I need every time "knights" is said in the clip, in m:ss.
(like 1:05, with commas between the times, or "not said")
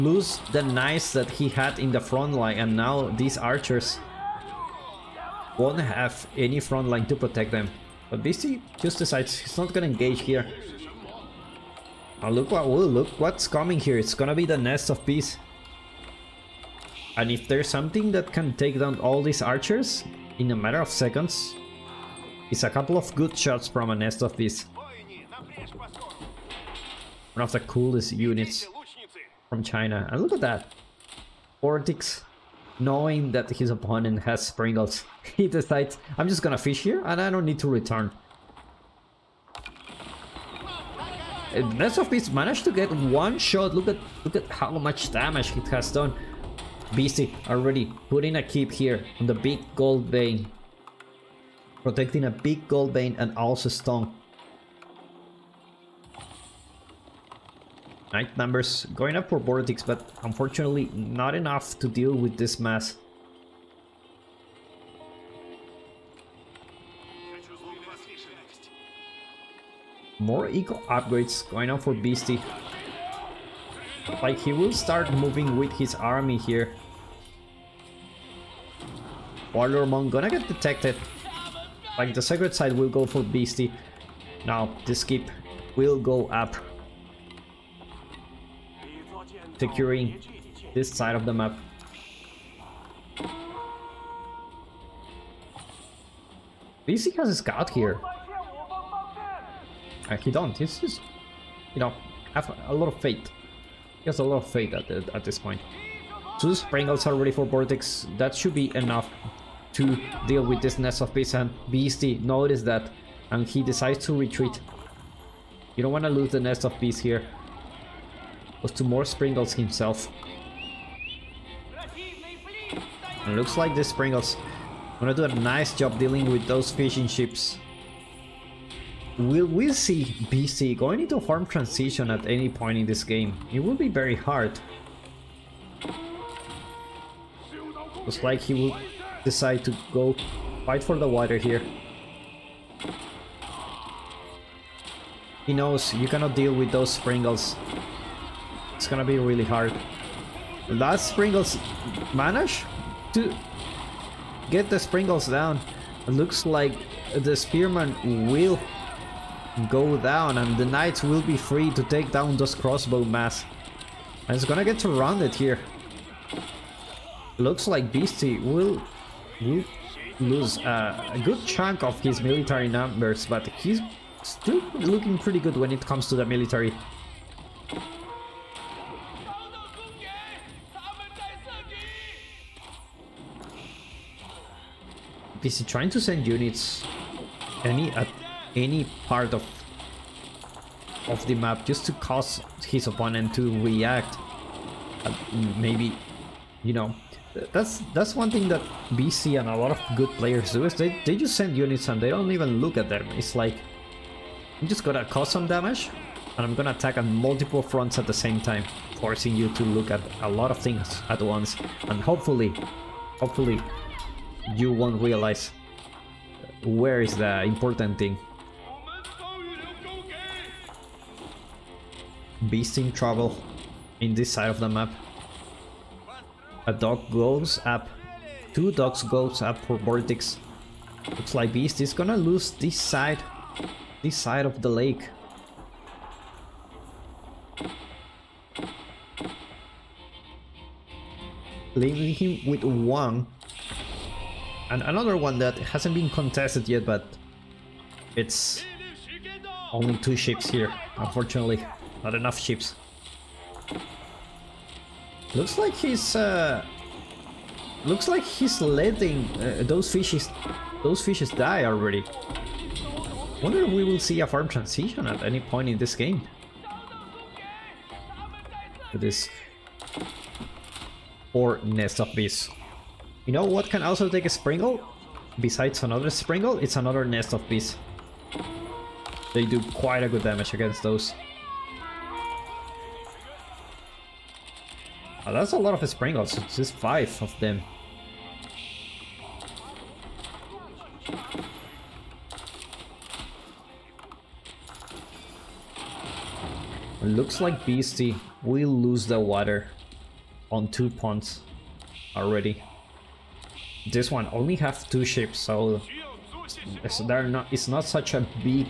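0:00, 2:40.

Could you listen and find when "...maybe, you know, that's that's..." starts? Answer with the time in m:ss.
3:15.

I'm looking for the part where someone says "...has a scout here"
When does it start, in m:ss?
1:37.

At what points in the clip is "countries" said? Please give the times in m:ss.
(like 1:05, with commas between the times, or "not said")
not said.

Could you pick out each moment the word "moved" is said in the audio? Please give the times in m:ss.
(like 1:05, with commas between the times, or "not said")
not said.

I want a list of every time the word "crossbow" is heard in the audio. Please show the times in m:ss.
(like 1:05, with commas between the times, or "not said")
2:42.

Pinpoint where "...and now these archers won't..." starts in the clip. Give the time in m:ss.
0:02.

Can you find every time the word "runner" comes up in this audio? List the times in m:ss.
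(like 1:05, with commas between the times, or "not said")
not said.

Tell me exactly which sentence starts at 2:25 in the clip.
He knows you cannot deal with those Springles gonna be really hard.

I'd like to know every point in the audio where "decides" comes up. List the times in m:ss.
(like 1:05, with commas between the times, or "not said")
0:08, 0:35, 1:53, 2:19.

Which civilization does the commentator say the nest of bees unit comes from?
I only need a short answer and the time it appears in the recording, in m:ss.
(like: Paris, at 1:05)
China, at 0:29.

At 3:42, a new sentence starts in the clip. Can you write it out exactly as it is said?
Beast in trouble in this side of the map.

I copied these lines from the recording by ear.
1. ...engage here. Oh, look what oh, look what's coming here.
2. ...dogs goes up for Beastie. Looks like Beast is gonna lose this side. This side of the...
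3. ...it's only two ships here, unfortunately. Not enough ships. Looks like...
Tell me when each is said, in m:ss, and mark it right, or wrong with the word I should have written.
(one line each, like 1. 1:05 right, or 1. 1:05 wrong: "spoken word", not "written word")
1. 0:09 right
2. 3:48 wrong: "VortiX", not "Beastie"
3. 4:08 right.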